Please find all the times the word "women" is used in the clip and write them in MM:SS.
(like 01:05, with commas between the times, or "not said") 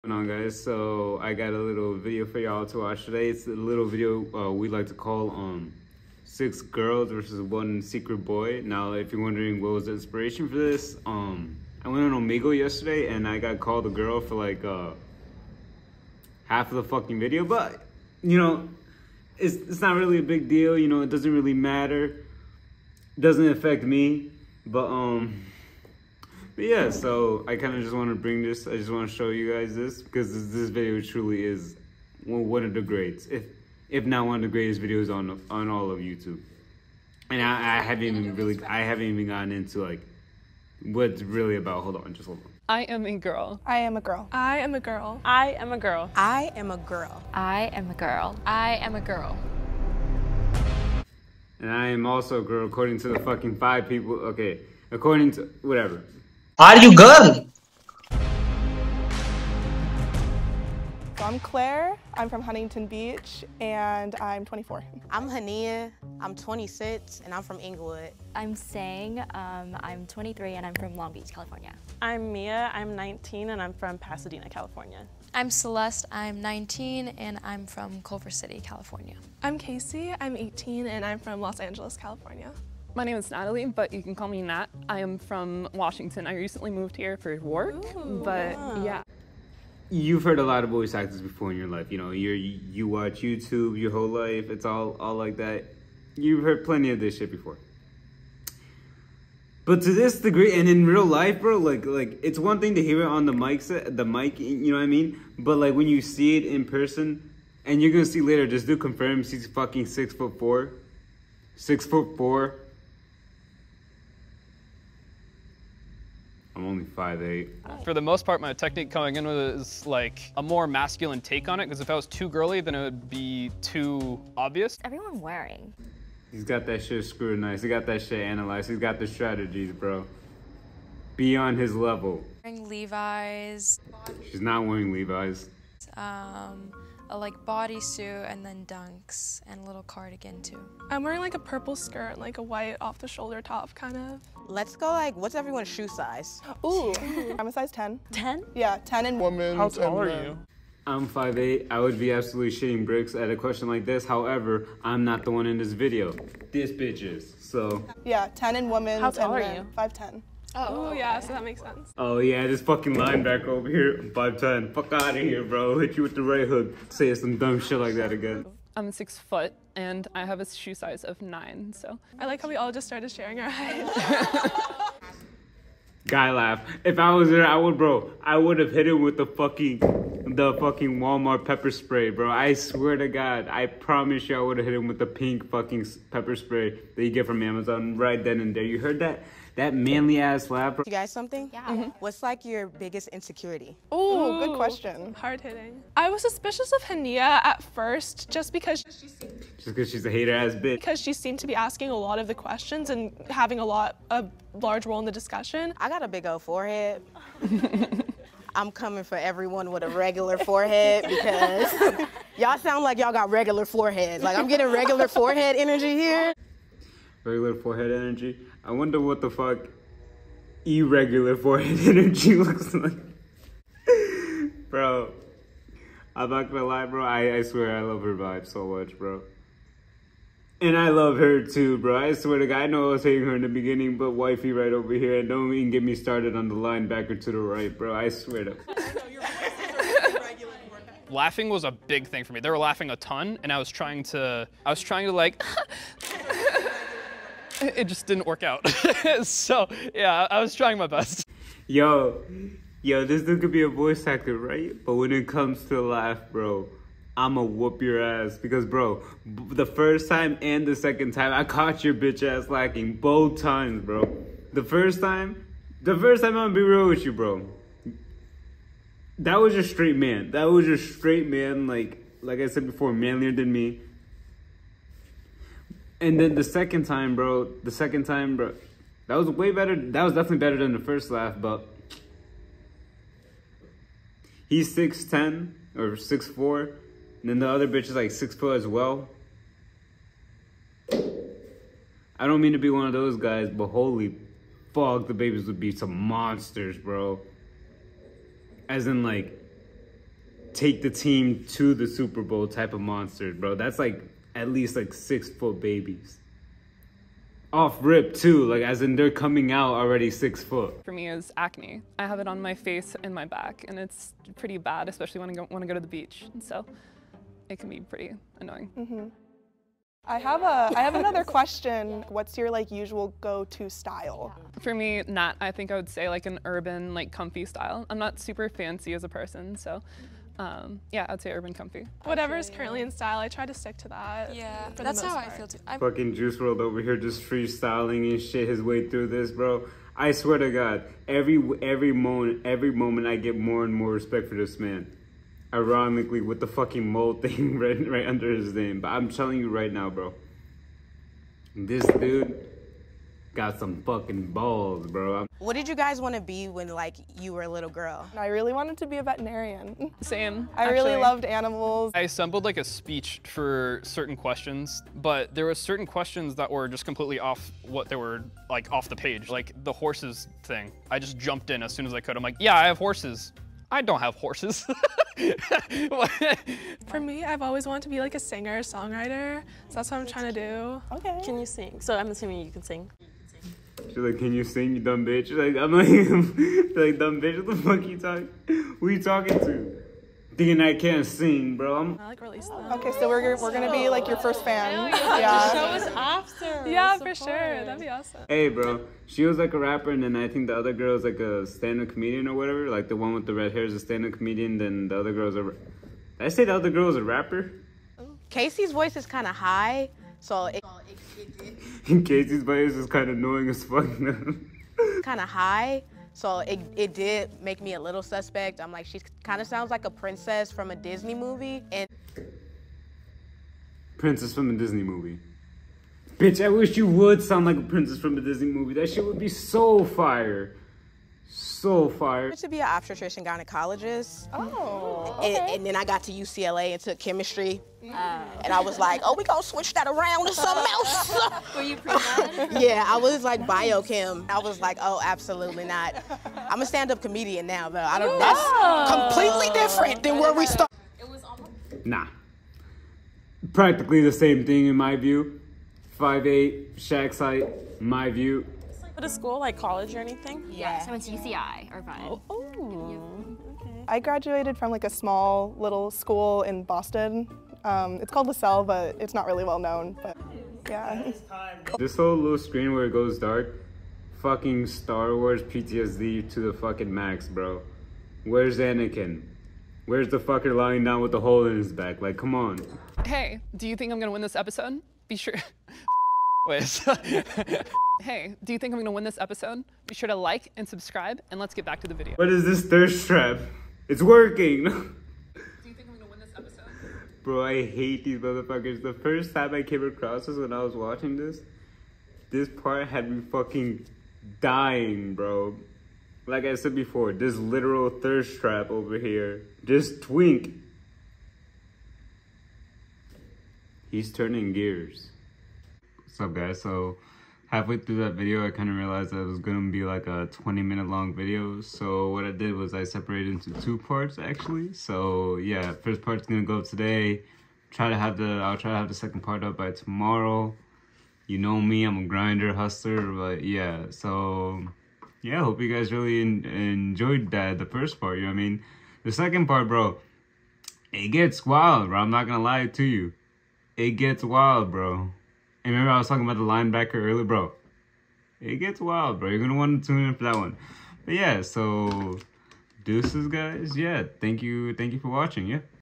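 02:29, 02:38.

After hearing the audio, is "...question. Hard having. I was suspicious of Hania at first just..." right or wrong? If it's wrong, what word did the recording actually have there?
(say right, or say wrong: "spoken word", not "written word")
wrong: "hitting", not "having".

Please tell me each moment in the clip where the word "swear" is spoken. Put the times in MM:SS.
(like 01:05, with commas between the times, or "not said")
03:02, 03:47, 03:52, 03:58, 05:40.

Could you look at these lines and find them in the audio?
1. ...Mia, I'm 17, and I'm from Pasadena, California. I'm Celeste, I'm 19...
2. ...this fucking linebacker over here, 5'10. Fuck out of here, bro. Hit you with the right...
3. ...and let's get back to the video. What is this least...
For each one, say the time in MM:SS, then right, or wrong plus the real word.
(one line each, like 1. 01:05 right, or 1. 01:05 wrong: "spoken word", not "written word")
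1. 01:12 wrong: "19", not "17"
2. 02:42 right
3. 08:11 wrong: "thirst", not "least".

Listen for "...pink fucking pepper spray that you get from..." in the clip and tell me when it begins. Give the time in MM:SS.
03:05.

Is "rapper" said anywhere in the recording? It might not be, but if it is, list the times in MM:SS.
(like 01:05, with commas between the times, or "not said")
06:39, 06:47.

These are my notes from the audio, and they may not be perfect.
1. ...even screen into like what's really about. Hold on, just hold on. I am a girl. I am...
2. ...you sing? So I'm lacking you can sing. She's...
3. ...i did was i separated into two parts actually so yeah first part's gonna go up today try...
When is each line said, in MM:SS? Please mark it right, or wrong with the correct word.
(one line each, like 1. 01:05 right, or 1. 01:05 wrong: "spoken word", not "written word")
1. 00:39 wrong: "gotten", not "screen"
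2. 06:21 wrong: "assuming", not "lacking"
3. 08:42 right.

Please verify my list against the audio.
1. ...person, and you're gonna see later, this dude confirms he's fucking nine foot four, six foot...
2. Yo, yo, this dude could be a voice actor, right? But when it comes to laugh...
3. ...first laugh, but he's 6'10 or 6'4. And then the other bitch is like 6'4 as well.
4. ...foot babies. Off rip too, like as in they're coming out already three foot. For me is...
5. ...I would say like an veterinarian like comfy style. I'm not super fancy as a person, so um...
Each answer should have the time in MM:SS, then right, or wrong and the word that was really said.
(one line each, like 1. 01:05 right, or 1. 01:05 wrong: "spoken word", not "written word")
1. 01:46 wrong: "six", not "nine"
2. 04:11 right
3. 04:40 right
4. 05:05 wrong: "six", not "three"
5. 05:25 wrong: "urban", not "veterinarian".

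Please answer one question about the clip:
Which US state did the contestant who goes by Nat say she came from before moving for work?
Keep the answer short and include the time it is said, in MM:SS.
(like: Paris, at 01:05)
Washington, at 01:25.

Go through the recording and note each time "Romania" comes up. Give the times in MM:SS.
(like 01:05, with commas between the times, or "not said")
not said.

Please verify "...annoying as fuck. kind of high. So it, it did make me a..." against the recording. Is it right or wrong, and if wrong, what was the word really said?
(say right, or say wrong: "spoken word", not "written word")
right.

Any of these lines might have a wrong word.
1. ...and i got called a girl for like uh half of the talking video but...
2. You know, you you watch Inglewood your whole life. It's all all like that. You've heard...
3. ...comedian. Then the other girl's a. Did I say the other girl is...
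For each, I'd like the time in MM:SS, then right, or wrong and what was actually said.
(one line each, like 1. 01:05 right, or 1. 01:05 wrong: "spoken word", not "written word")
1. 00:13 wrong: "fucking", not "talking"
2. 01:31 wrong: "YouTube", not "Inglewood"
3. 06:44 right.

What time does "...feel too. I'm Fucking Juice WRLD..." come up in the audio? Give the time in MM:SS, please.
05:35.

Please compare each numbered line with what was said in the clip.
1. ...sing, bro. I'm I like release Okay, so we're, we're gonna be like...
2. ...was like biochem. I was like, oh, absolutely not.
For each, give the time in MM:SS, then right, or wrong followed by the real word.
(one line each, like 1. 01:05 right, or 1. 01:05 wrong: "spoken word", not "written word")
1. 06:31 right
2. 07:22 right.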